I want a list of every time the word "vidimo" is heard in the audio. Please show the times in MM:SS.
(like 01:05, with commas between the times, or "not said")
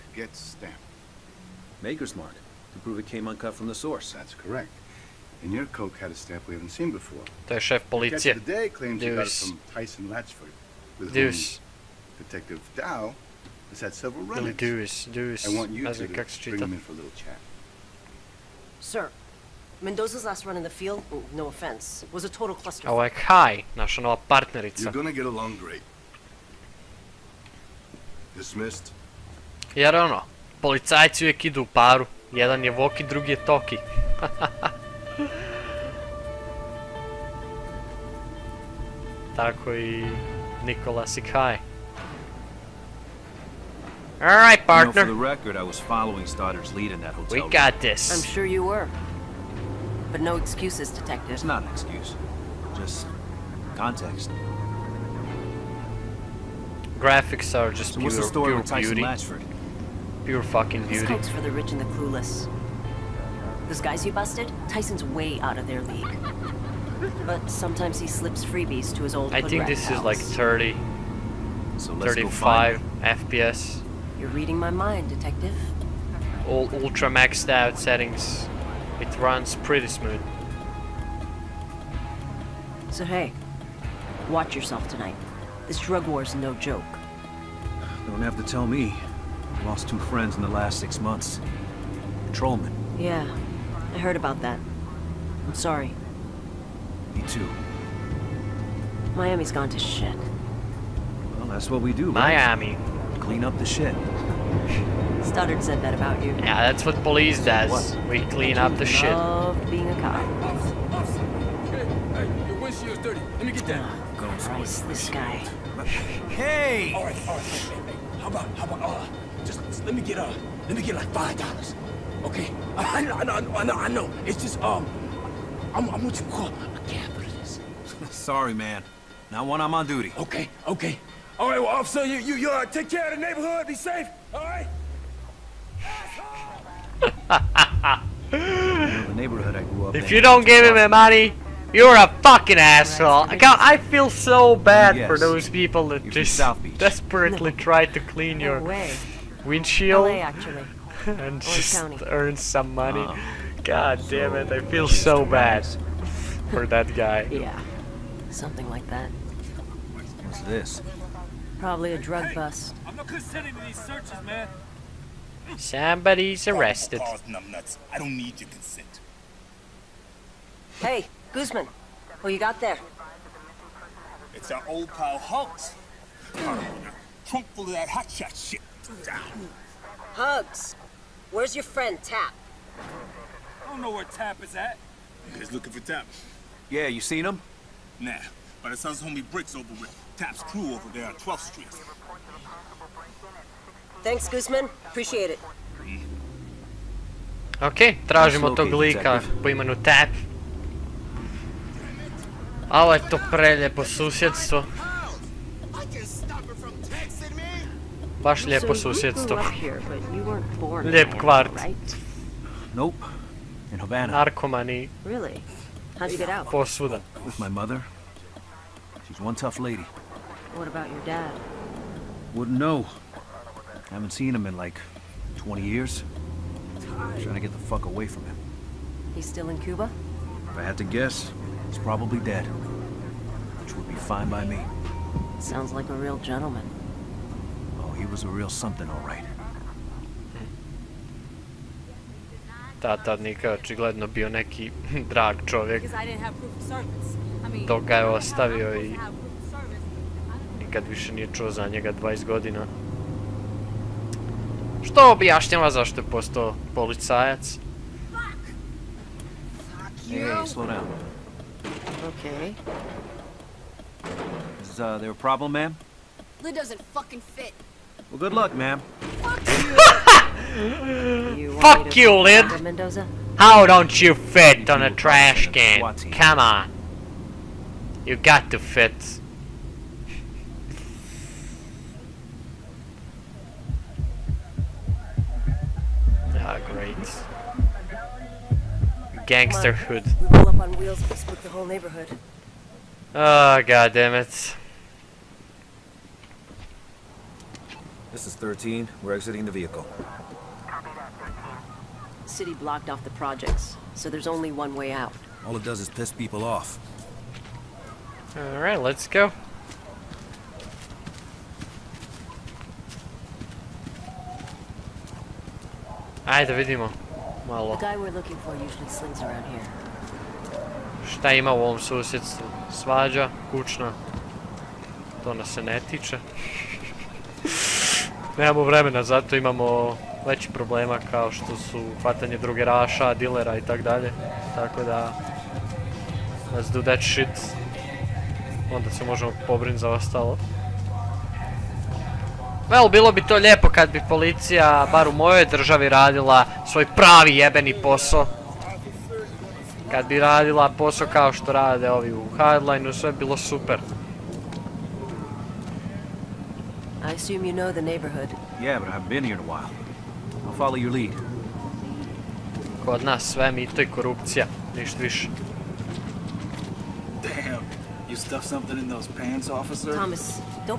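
05:16.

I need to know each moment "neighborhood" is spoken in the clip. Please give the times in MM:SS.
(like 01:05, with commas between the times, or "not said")
02:13, 04:51, 05:57.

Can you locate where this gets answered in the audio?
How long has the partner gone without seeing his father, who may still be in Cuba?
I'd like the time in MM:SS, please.
03:45.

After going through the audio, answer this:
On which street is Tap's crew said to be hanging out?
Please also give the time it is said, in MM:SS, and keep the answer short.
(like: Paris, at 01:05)
12th Street, at 03:11.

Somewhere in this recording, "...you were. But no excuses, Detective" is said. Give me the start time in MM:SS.
00:48.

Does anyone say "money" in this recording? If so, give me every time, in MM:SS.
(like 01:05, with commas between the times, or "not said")
02:20, 02:32.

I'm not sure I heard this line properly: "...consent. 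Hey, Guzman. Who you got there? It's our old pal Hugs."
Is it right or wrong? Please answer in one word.
right.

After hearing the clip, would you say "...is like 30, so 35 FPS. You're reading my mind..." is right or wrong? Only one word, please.
right.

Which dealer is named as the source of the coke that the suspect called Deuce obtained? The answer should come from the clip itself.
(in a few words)
Tyson Latchford.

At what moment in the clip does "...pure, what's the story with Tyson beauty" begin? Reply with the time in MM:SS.
00:57.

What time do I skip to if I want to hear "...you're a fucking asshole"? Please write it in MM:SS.
02:21.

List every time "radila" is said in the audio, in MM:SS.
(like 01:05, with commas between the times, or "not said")
05:45, 05:50.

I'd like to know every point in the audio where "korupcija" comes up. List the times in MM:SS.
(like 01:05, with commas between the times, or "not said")
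06:03.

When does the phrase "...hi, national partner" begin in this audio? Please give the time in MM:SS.
00:23.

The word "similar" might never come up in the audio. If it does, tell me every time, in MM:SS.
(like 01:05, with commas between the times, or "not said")
not said.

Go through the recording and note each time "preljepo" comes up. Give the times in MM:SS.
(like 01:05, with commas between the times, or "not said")
03:23.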